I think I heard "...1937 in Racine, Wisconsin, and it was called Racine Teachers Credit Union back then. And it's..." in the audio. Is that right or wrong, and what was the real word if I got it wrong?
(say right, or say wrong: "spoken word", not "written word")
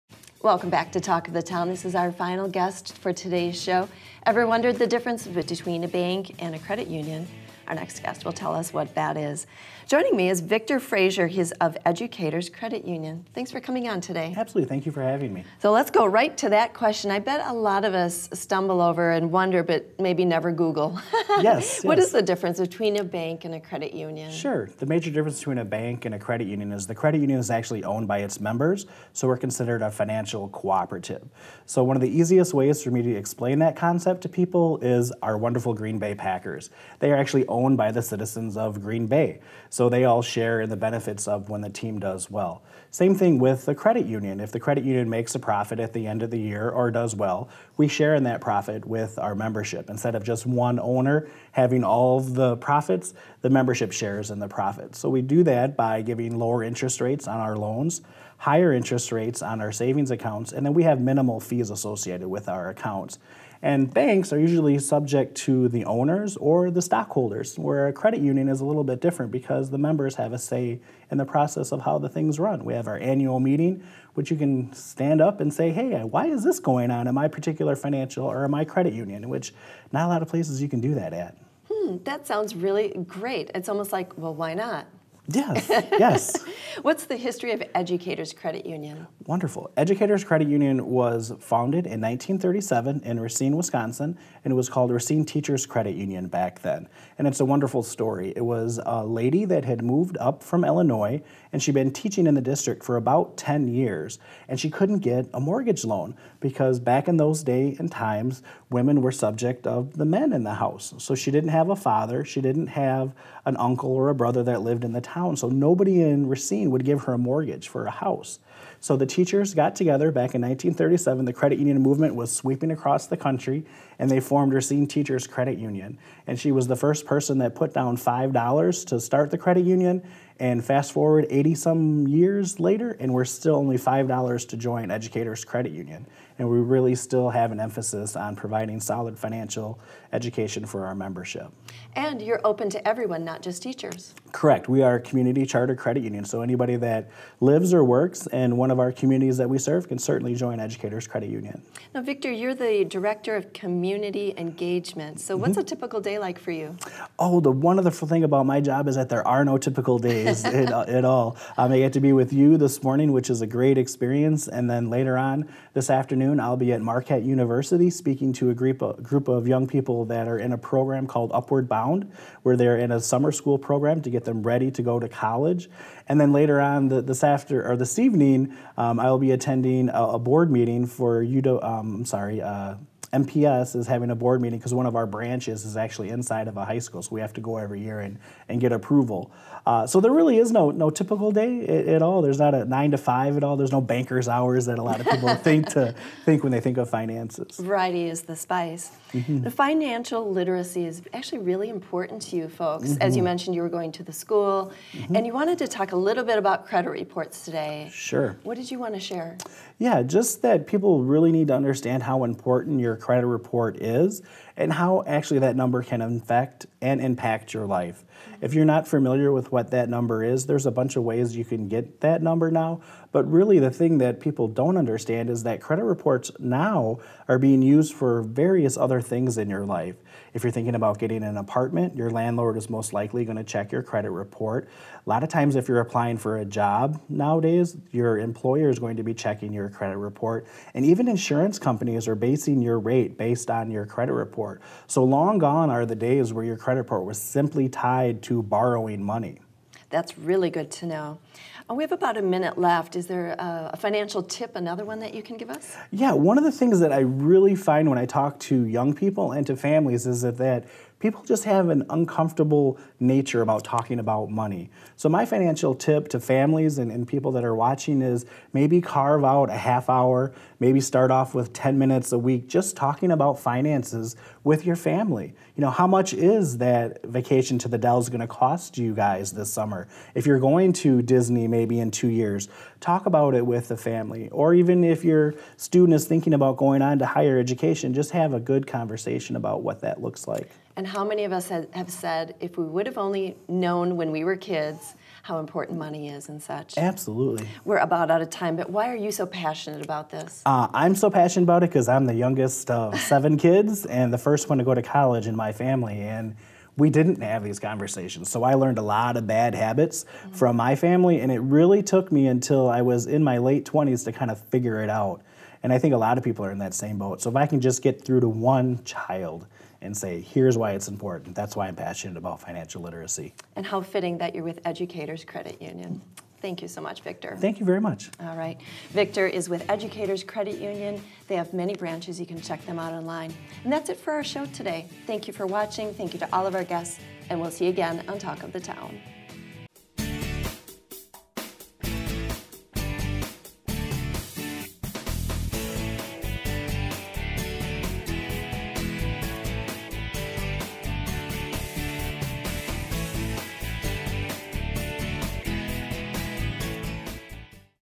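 right.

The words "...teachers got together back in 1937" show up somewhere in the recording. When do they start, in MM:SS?
01:59.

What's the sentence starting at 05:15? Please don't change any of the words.
And I think a lot of people are in that same boat.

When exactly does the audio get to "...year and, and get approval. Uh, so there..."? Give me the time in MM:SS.
03:07.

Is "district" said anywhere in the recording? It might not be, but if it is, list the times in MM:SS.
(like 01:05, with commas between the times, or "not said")
01:42.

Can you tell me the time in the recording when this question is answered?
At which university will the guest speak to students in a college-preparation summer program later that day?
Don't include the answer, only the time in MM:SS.
02:46.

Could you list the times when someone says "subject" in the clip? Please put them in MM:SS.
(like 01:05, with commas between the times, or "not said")
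01:04, 01:49.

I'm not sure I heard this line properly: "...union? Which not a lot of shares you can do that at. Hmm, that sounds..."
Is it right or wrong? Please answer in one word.
wrong.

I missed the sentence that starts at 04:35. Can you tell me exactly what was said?
You know, how much is that vacation to the Dells going to cost you guys this summer?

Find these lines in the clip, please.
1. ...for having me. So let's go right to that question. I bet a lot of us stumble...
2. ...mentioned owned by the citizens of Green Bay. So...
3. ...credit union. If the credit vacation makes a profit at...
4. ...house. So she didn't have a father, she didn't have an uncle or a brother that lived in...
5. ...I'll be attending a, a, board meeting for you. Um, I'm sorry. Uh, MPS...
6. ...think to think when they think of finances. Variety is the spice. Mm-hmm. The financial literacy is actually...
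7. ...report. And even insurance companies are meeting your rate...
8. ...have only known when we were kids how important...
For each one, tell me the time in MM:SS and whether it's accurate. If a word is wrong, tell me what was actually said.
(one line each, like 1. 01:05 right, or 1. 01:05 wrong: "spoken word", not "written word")
1. 00:14 right
2. 00:37 wrong: "owned", not "mentioned"
3. 00:43 wrong: "union", not "vacation"
4. 01:50 right
5. 02:59 right
6. 03:15 right
7. 03:59 wrong: "basing", not "meeting"
8. 04:52 right.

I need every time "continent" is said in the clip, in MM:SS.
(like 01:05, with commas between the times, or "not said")
not said.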